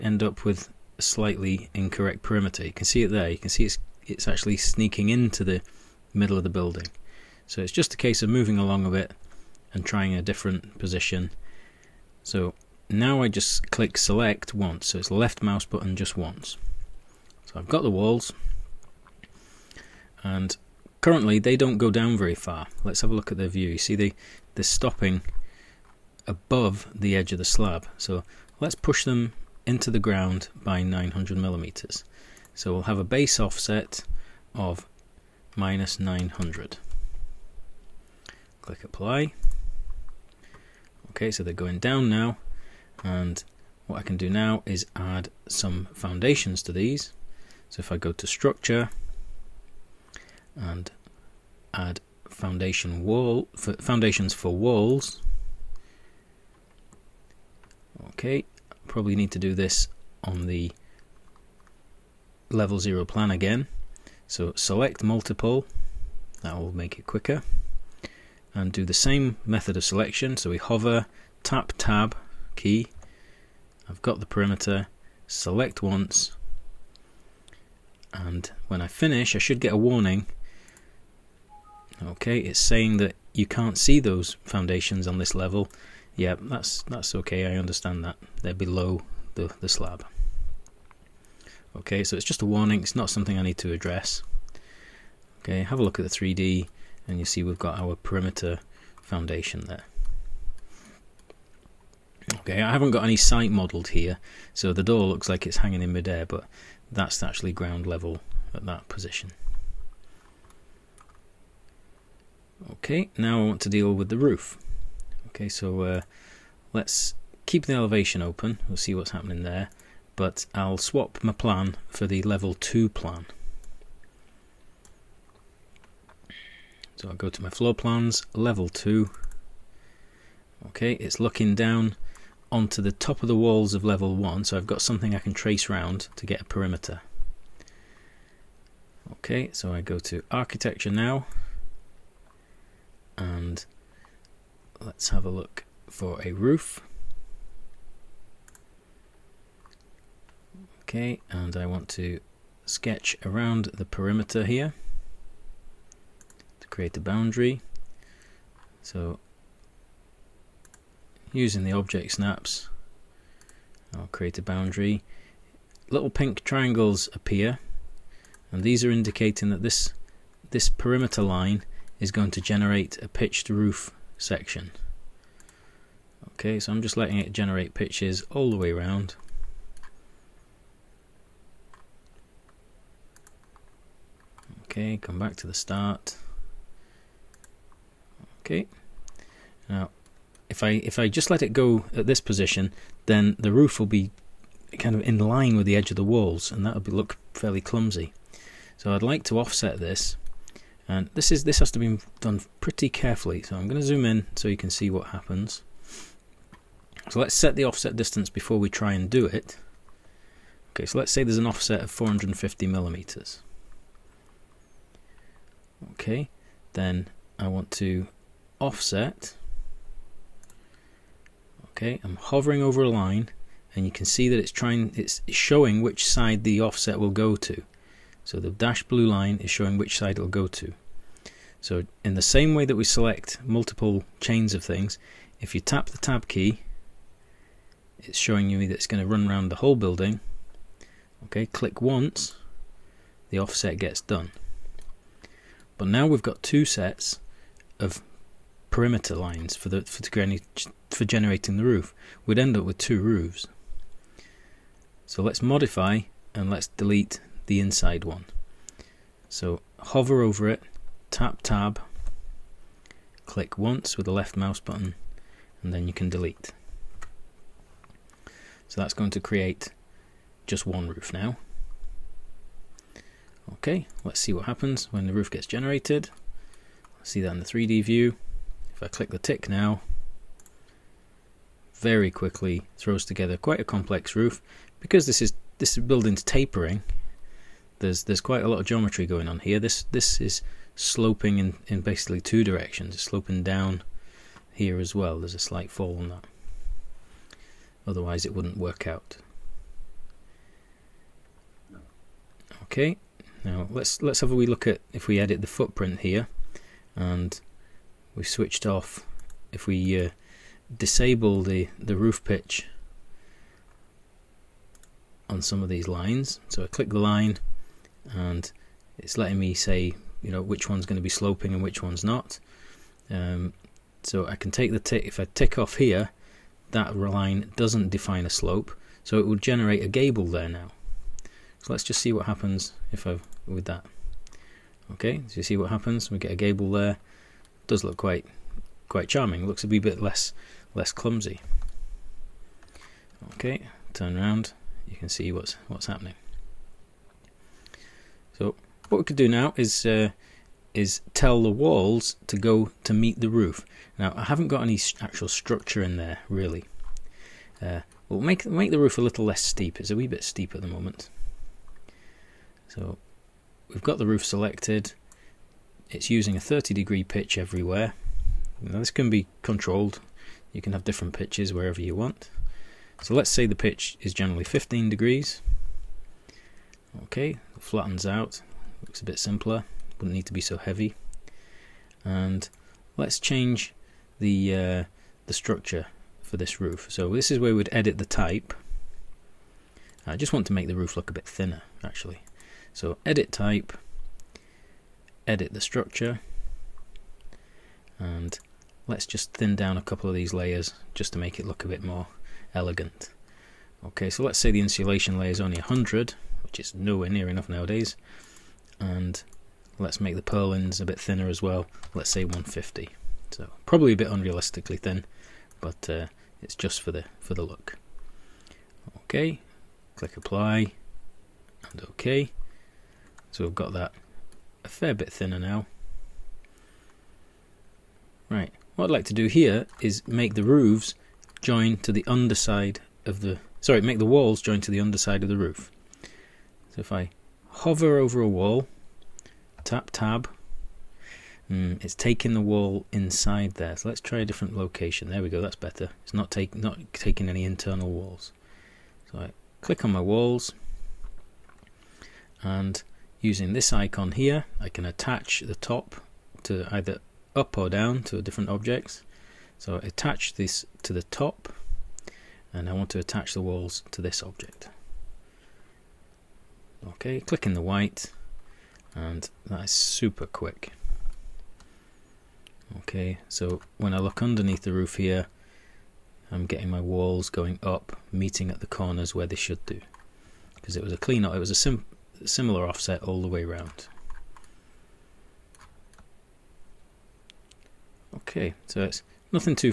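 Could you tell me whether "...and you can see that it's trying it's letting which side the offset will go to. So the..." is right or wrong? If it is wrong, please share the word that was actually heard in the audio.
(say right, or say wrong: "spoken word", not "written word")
wrong: "showing", not "letting".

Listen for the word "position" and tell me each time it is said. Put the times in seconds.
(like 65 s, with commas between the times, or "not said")
10 s, 108 s, 192 s.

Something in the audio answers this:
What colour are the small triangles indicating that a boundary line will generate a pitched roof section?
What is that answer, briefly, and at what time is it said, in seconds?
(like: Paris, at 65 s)
pink, at 166 s.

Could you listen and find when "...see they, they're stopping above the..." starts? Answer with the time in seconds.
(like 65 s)
23 s.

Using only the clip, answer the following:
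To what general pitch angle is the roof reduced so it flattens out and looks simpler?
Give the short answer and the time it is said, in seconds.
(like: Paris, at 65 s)
15 degrees, at 374 s.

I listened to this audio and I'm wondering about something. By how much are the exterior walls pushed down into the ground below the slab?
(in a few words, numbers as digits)
900 millimeters.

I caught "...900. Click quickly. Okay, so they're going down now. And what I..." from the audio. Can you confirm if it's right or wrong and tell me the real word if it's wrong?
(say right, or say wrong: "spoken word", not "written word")
wrong: "apply", not "quickly".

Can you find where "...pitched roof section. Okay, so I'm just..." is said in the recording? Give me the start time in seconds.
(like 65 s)
173 s.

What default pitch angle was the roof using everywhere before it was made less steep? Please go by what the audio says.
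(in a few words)
30 degrees.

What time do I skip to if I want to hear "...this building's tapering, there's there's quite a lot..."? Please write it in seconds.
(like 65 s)
285 s.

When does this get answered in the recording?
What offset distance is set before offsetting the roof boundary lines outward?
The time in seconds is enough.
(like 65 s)
211 s.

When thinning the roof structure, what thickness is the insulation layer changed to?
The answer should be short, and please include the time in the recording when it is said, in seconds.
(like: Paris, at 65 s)
100, at 405 s.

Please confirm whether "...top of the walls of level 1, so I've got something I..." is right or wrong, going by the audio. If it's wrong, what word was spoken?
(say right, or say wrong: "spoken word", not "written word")
right.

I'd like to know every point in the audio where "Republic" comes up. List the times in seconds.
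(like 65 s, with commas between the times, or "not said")
not said.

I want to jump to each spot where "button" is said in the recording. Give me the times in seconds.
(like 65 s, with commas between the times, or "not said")
15 s, 264 s.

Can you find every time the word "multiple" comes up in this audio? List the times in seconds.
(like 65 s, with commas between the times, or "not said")
65 s, 233 s.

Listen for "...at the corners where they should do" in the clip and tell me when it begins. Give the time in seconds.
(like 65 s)
478 s.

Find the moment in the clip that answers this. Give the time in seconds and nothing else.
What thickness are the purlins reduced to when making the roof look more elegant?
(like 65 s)
412 s.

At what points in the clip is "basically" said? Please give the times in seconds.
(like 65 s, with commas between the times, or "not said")
291 s.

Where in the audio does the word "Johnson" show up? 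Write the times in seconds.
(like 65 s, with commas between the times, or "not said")
not said.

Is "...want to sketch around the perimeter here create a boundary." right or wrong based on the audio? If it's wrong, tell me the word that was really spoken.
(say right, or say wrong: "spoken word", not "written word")
right.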